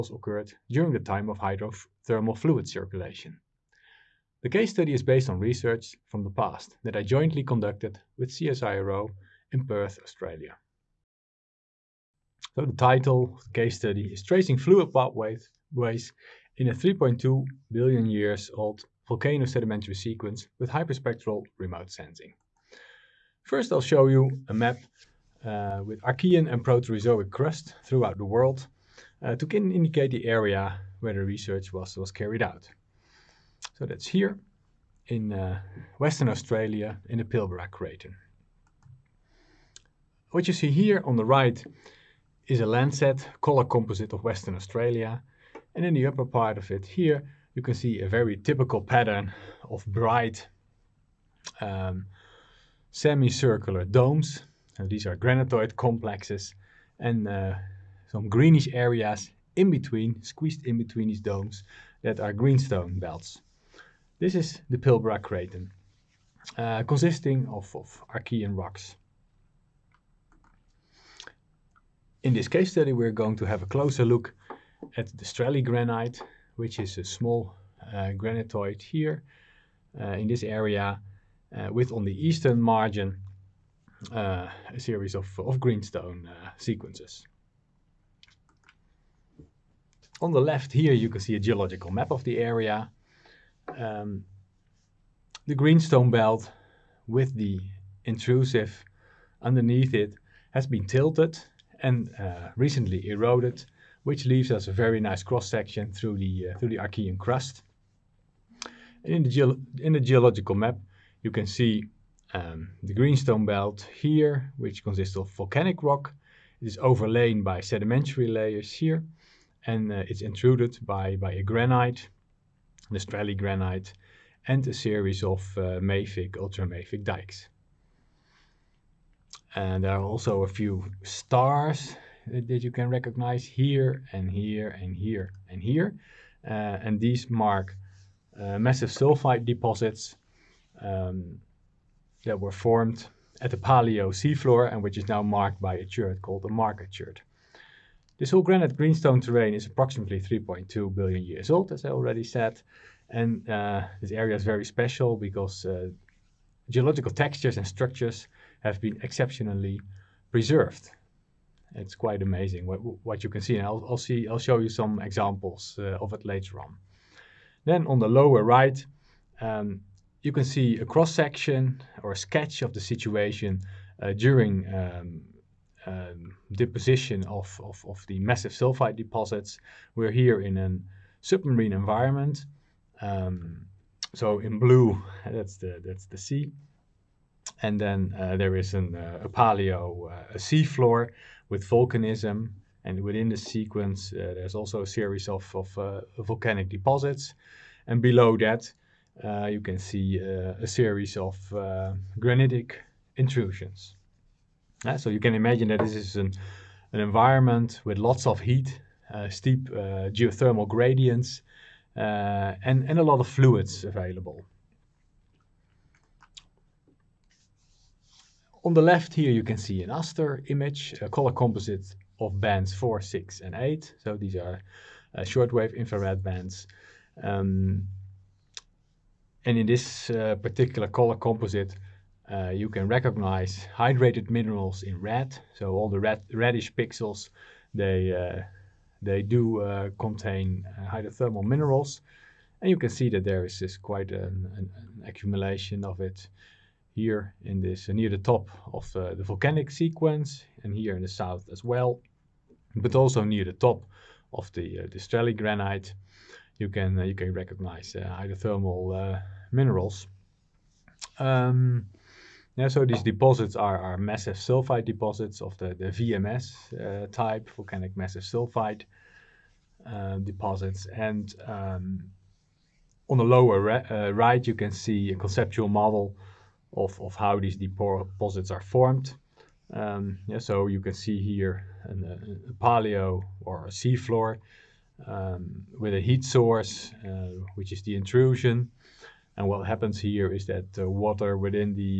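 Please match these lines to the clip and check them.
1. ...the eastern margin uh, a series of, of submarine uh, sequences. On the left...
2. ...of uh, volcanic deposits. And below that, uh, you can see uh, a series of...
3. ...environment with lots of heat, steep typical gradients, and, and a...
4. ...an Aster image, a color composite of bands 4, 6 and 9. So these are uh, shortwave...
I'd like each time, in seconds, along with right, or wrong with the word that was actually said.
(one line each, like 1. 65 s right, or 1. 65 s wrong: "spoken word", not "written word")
1. 82 s wrong: "greenstone", not "submarine"
2. 195 s right
3. 206 s wrong: "geothermal", not "typical"
4. 219 s wrong: "8", not "9".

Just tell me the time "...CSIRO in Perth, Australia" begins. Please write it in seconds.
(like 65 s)
8 s.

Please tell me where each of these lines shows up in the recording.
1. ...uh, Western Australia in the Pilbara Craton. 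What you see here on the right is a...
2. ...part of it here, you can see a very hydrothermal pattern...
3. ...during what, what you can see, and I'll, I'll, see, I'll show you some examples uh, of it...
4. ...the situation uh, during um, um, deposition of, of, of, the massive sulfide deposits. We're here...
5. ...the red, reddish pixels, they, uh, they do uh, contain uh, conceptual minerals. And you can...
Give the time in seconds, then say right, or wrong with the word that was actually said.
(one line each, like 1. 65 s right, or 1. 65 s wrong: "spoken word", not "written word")
1. 35 s right
2. 46 s wrong: "typical", not "hydrothermal"
3. 162 s wrong: "amazing", not "during"
4. 172 s right
5. 235 s wrong: "hydrothermal", not "conceptual".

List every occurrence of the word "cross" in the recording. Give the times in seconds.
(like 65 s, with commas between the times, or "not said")
105 s, 170 s.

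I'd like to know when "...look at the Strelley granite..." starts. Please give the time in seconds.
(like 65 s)
74 s.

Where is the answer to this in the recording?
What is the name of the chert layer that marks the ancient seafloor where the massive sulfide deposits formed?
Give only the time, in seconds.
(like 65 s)
146 s.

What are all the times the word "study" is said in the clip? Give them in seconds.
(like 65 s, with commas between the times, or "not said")
4 s, 13 s, 72 s.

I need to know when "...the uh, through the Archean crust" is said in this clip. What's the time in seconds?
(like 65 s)
106 s.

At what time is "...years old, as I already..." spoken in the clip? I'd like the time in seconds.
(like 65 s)
151 s.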